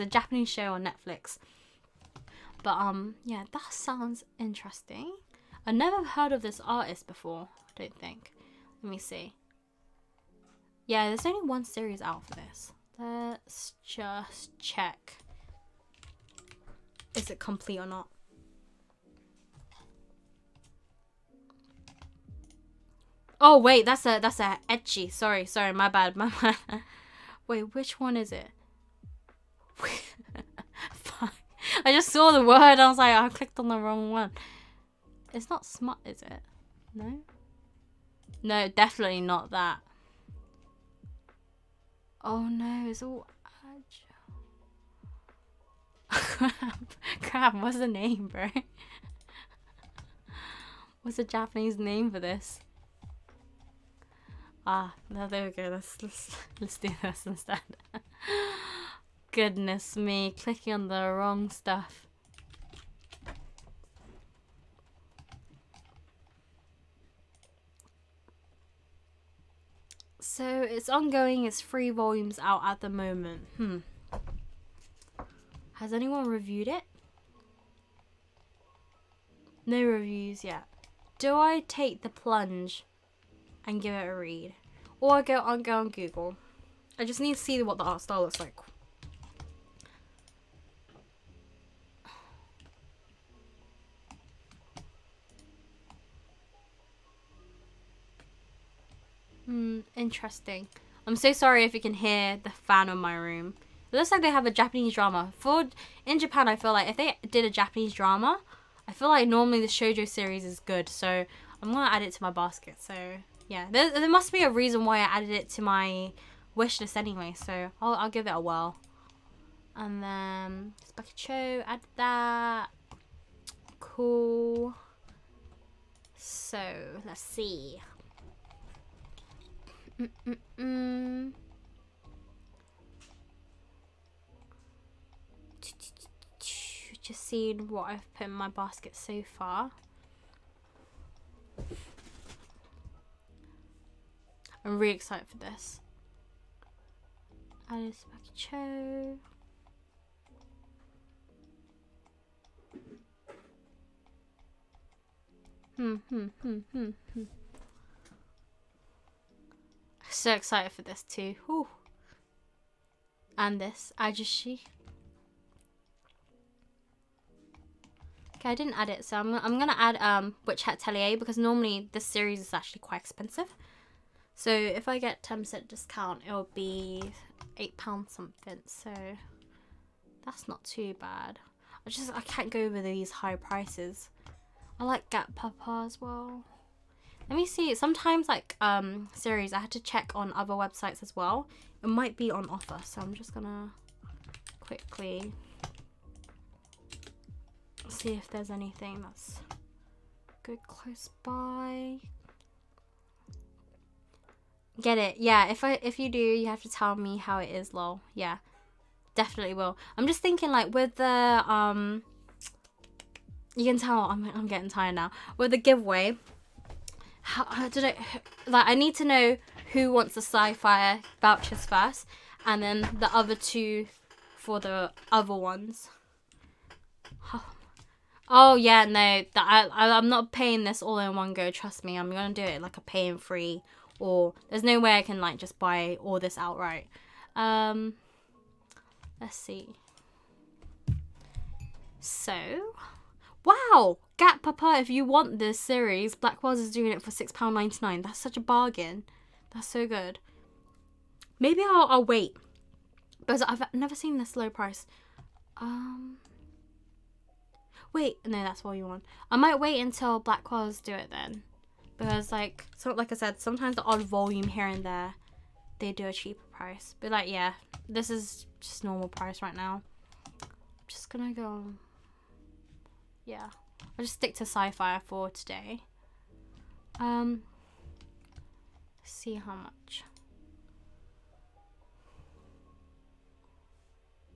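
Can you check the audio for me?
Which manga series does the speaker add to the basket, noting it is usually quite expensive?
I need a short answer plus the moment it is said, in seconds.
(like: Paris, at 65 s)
Witch Hat Atelier, at 170 s.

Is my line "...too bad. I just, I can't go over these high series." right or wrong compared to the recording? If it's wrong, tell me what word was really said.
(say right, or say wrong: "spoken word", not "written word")
wrong: "prices", not "series".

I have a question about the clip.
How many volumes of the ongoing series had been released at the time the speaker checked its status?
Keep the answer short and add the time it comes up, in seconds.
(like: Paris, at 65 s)
3, at 71 s.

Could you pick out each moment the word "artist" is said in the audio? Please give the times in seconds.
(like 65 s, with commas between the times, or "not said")
6 s.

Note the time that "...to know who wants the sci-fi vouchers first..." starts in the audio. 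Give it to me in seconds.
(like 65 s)
218 s.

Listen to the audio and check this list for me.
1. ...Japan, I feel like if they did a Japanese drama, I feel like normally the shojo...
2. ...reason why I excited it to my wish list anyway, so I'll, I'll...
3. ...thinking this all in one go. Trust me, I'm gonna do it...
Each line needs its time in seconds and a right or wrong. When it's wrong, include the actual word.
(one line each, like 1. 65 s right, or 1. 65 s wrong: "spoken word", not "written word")
1. 106 s right
2. 114 s wrong: "added", not "excited"
3. 230 s wrong: "paying", not "thinking".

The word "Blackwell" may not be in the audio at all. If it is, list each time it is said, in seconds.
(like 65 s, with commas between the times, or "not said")
246 s, 260 s.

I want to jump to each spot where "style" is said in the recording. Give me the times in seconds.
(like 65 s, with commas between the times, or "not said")
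88 s.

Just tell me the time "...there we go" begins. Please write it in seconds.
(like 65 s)
55 s.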